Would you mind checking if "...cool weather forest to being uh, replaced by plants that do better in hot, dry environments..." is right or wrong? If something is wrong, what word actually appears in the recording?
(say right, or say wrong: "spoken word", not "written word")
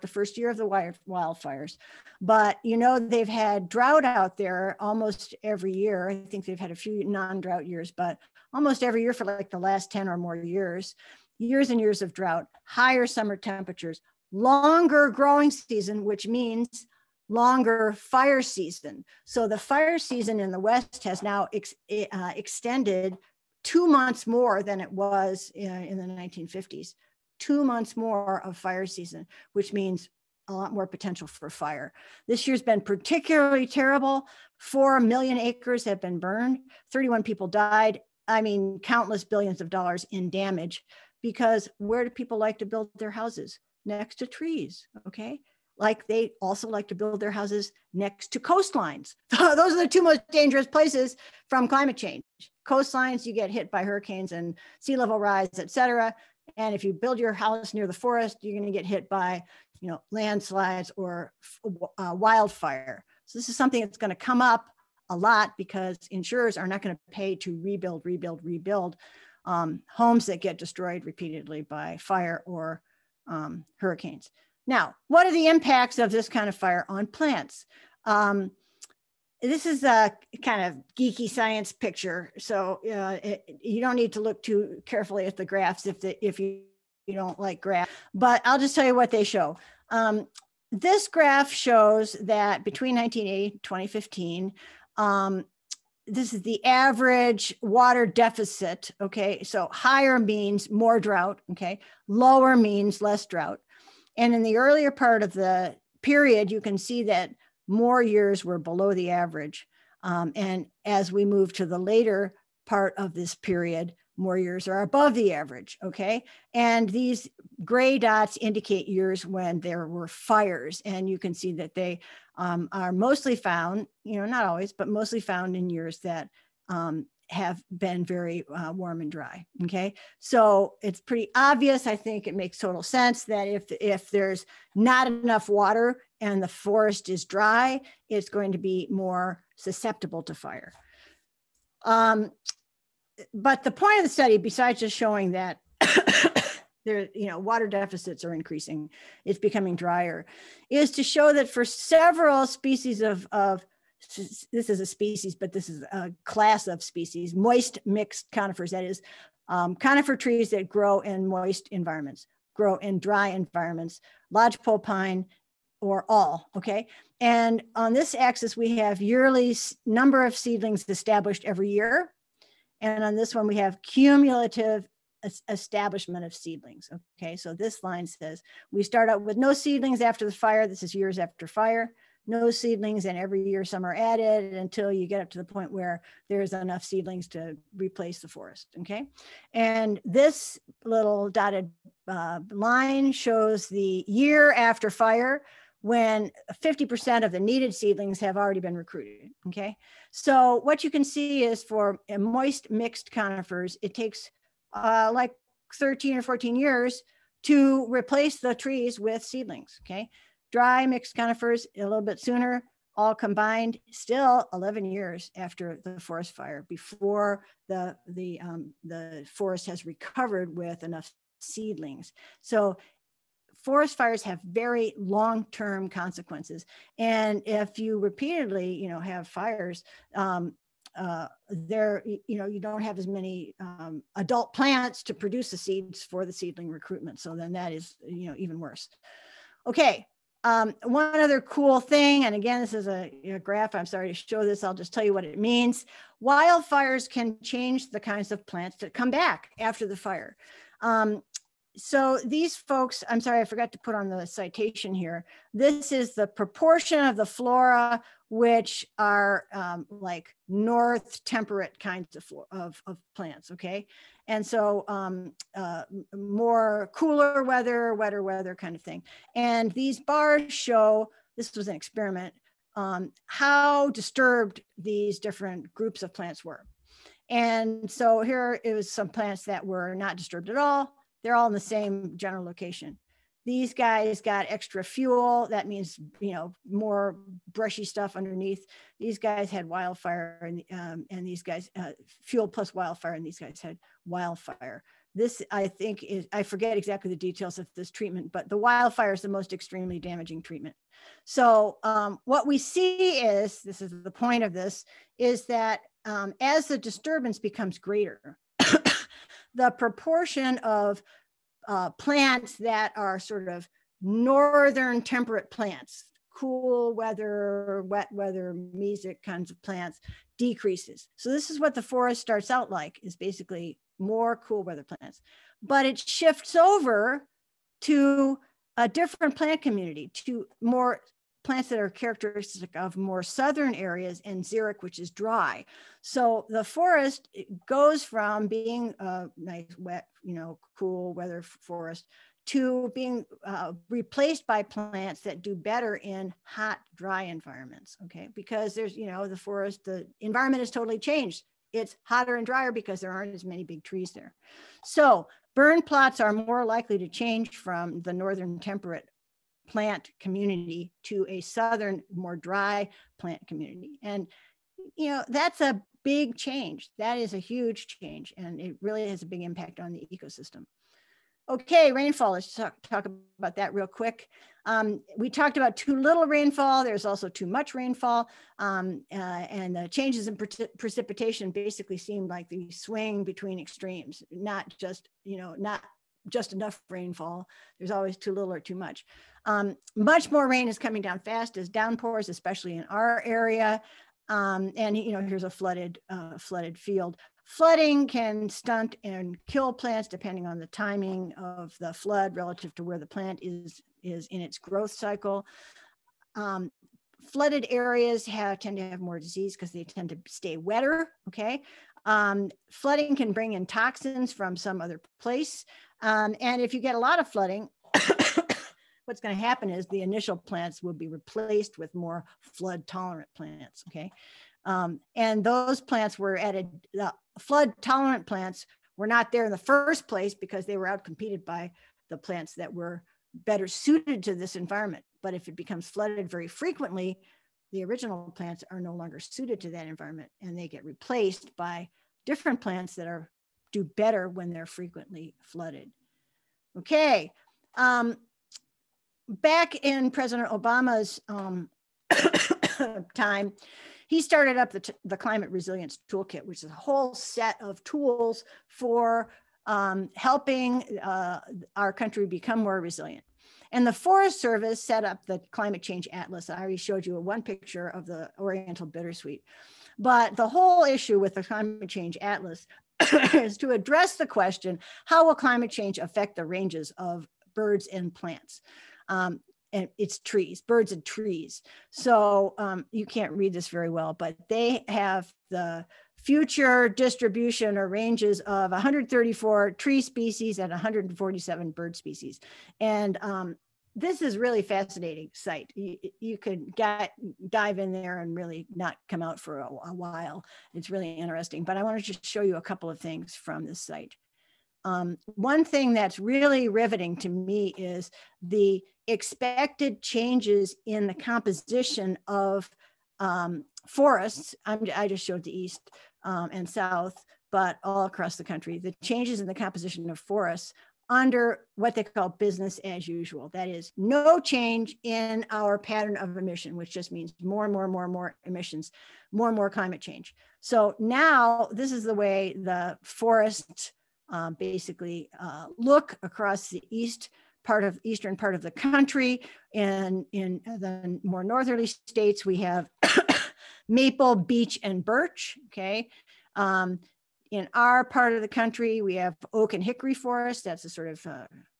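right.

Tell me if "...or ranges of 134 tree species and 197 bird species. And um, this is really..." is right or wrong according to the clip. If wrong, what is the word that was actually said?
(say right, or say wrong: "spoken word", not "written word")
wrong: "147", not "197".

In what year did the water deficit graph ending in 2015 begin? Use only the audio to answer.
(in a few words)
1980.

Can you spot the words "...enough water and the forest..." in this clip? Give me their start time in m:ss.
2:15.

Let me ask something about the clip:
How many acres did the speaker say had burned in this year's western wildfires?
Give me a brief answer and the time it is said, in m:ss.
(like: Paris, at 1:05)
4 million acres, at 0:34.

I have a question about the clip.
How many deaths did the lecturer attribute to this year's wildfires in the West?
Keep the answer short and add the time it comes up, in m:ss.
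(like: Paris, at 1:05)
31, at 0:36.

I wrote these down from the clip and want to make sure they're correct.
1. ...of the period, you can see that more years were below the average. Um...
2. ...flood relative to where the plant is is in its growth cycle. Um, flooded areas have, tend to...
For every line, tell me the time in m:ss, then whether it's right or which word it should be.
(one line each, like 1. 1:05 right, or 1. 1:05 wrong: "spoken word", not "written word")
1. 1:45 right
2. 6:41 right.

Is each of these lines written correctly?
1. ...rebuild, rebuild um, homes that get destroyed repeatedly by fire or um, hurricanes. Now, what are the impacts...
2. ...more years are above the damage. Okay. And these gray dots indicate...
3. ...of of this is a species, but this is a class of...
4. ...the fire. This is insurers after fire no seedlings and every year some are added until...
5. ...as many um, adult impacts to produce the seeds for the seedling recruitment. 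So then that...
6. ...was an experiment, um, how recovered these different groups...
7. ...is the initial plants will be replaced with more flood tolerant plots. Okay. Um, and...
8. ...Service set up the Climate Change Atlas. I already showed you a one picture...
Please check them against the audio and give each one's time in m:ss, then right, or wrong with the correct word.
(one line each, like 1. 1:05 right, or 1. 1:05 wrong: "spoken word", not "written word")
1. 1:08 right
2. 1:54 wrong: "average", not "damage"
3. 2:33 right
4. 3:00 wrong: "years", not "insurers"
5. 3:52 wrong: "plants", not "impacts"
6. 4:31 wrong: "disturbed", not "recovered"
7. 6:59 wrong: "plants", not "plots"
8. 7:44 right.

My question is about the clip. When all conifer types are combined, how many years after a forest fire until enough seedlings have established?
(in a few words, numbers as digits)
11 years.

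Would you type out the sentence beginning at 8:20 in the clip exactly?
It's really interesting, but I wanted to show you a couple of things from this site.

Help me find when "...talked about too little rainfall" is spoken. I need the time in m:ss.
6:15.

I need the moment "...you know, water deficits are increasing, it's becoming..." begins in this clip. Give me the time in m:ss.
2:27.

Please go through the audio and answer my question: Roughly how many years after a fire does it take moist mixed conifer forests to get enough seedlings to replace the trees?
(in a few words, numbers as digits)
13 or 14 years.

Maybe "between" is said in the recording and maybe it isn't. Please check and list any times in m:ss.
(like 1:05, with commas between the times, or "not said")
1:32, 6:23.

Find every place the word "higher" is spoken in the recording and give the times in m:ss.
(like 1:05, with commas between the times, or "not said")
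0:12, 1:39.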